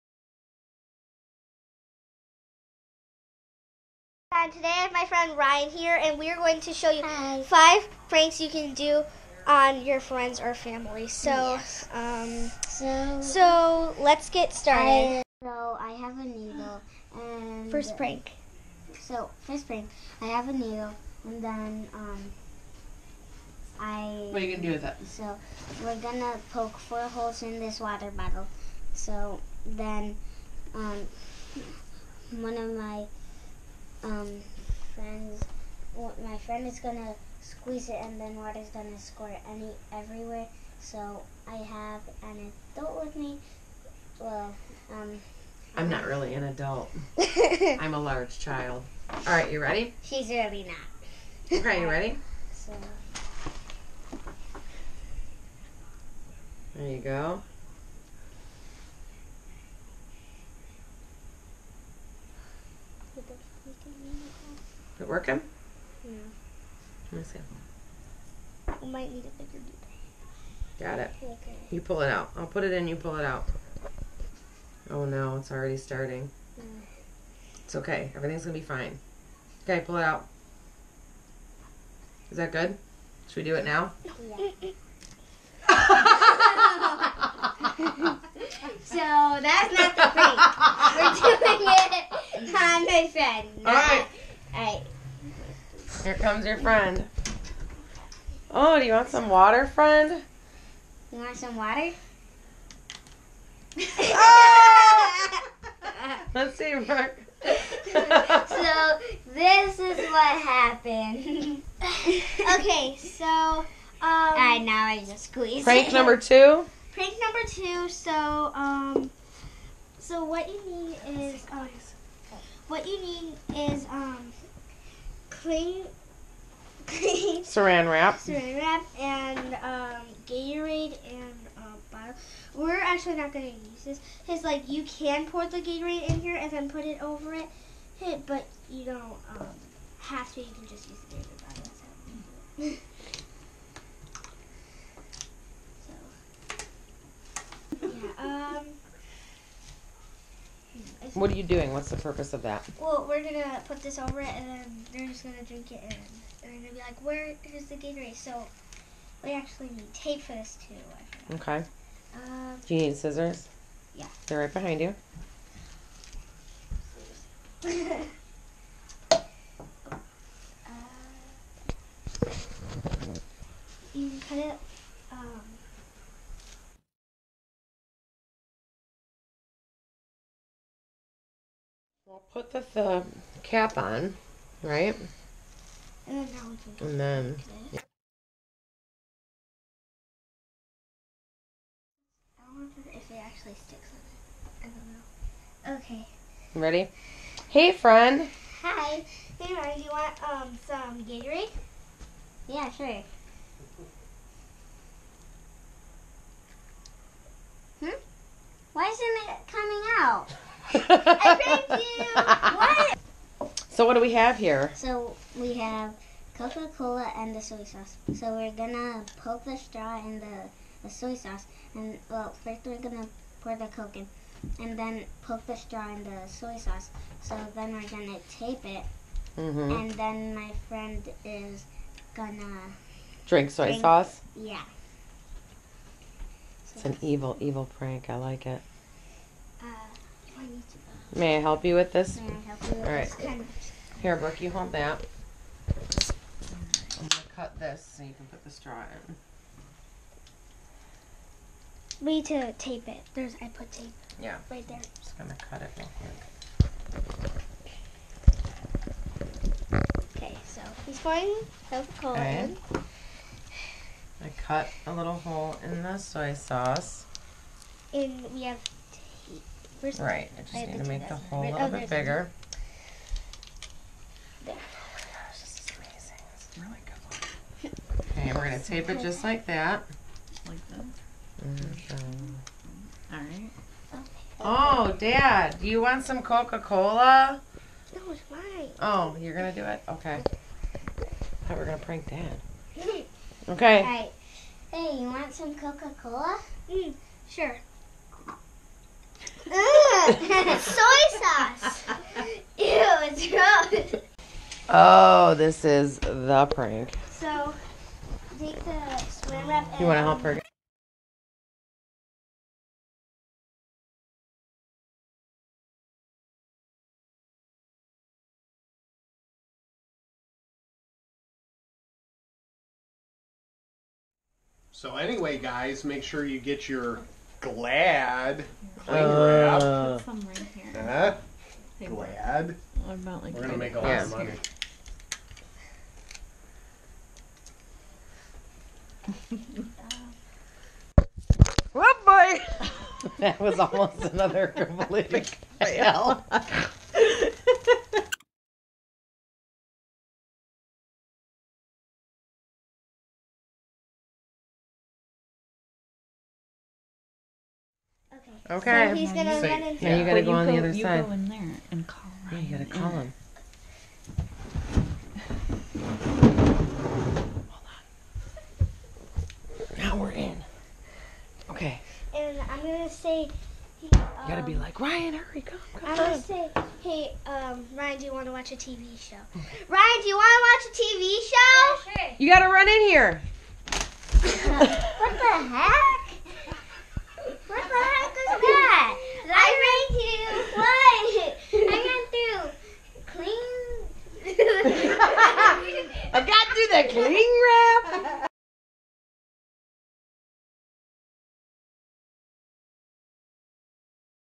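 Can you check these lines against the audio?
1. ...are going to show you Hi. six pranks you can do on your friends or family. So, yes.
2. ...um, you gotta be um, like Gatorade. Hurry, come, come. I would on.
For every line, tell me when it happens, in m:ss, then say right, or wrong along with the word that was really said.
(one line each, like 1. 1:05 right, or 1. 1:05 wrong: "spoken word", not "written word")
1. 0:06 wrong: "five", not "six"
2. 6:13 wrong: "Ryan", not "Gatorade".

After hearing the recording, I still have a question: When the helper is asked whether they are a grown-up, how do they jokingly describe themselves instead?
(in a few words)
A large child.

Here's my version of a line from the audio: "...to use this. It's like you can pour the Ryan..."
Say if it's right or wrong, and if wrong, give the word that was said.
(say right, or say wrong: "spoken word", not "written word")
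wrong: "Gatorade", not "Ryan".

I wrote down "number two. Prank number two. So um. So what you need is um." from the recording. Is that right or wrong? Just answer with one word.
right.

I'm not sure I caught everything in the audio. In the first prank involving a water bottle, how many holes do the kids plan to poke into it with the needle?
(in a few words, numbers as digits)
4.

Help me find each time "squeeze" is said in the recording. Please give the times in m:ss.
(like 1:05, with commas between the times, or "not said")
0:37, 1:55.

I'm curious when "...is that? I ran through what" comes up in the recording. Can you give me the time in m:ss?
6:28.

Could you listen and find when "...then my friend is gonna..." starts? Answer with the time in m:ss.
3:49.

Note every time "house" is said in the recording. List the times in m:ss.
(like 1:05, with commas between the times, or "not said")
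not said.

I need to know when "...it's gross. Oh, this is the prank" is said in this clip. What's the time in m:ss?
5:02.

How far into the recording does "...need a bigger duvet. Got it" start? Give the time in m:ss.
1:09.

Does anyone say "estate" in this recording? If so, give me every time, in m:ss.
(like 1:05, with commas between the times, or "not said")
not said.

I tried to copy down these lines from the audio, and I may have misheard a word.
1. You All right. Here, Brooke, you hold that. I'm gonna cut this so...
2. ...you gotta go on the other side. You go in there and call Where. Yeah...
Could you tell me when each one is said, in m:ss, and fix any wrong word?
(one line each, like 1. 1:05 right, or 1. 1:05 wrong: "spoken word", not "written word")
1. 4:02 right
2. 5:59 wrong: "Ryan", not "Where".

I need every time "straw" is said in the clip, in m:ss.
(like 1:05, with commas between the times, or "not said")
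3:39, 3:45, 4:08.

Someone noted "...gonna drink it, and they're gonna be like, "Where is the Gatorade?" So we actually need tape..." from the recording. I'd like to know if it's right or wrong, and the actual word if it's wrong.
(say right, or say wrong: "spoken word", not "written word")
right.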